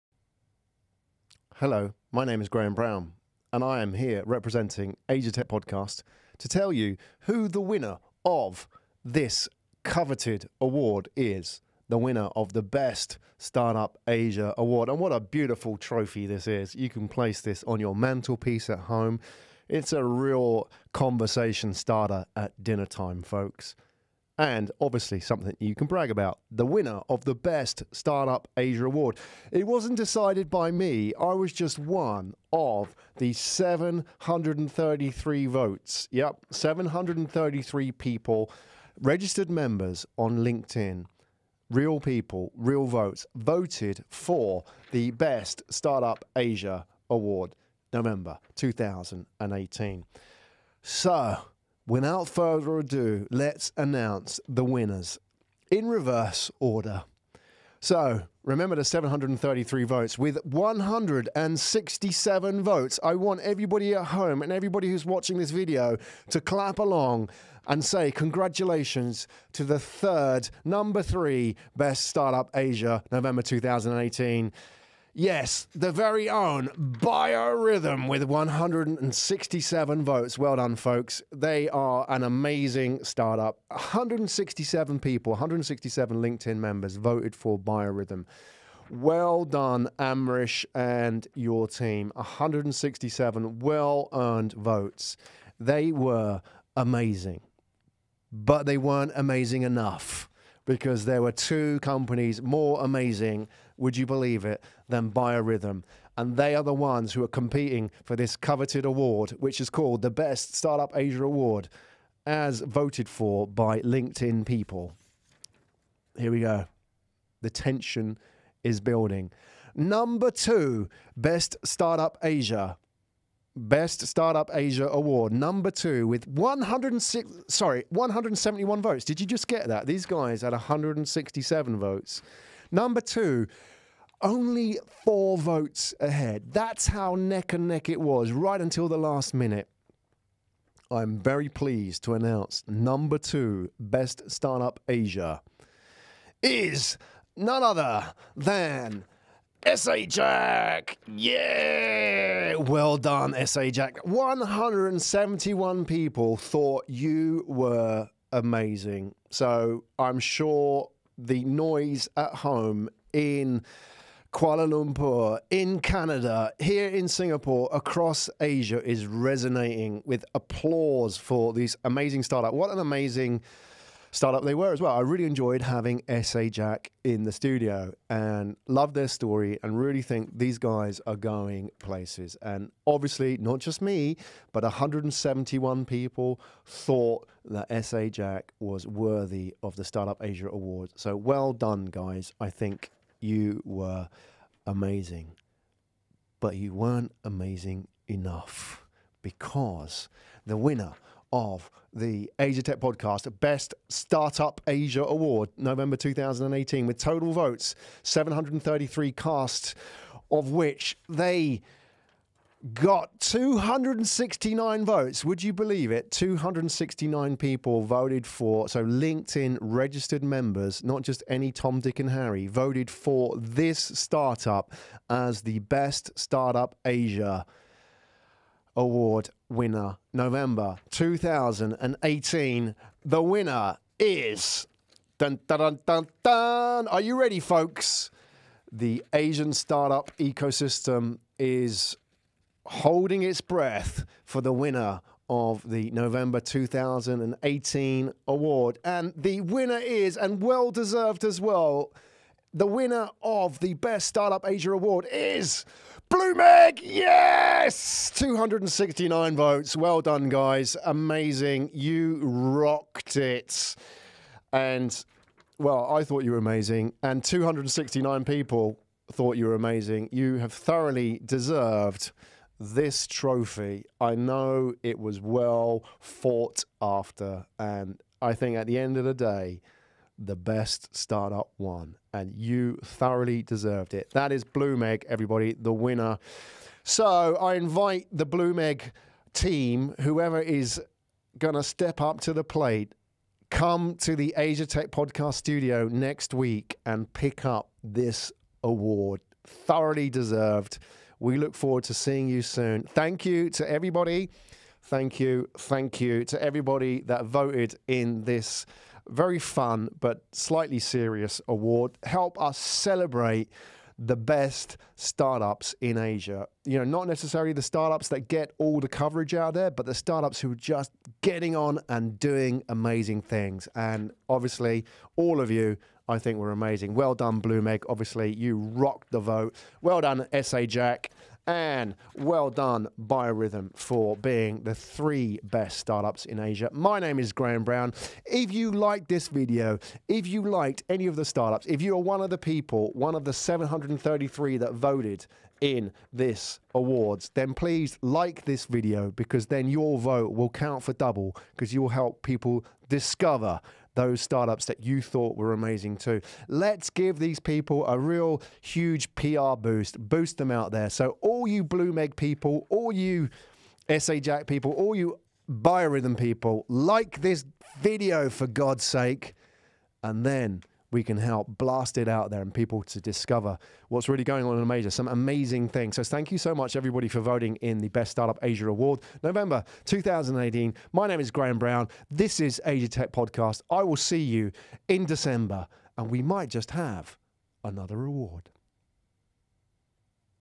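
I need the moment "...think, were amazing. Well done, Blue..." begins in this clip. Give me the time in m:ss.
5:26.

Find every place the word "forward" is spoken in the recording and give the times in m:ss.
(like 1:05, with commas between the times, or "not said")
5:01.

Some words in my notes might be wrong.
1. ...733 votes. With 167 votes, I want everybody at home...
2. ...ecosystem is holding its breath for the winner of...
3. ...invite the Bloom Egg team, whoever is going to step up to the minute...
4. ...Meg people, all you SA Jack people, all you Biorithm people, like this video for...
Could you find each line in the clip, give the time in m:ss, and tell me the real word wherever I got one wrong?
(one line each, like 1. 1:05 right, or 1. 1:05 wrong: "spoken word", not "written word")
1. 0:58 right
2. 4:00 right
3. 4:47 wrong: "plate", not "minute"
4. 6:01 right.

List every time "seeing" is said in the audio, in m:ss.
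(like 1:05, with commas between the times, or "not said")
5:01.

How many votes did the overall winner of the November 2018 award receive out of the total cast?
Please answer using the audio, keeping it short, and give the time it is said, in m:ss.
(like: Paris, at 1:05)
269, at 3:31.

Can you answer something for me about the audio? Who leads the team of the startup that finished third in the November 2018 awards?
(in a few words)
Amrish.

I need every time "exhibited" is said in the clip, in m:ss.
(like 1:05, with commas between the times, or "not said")
not said.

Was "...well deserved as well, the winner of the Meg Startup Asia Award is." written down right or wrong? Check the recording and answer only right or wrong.
wrong.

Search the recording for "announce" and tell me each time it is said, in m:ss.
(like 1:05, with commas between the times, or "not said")
0:53, 2:22.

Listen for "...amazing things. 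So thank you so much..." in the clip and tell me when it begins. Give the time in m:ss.
6:15.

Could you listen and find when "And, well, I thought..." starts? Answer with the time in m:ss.
4:24.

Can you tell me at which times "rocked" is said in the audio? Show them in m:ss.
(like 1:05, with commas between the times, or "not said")
4:22, 5:28.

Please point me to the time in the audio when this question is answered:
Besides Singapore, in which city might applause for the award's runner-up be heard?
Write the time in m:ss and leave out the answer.
2:44.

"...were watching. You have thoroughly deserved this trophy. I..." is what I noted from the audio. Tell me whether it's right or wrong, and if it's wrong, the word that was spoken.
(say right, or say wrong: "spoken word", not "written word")
wrong: "amazing", not "watching".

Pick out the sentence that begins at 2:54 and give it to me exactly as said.
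I really enjoyed having SA Jack in the studio and love their story and really think these guys are going places.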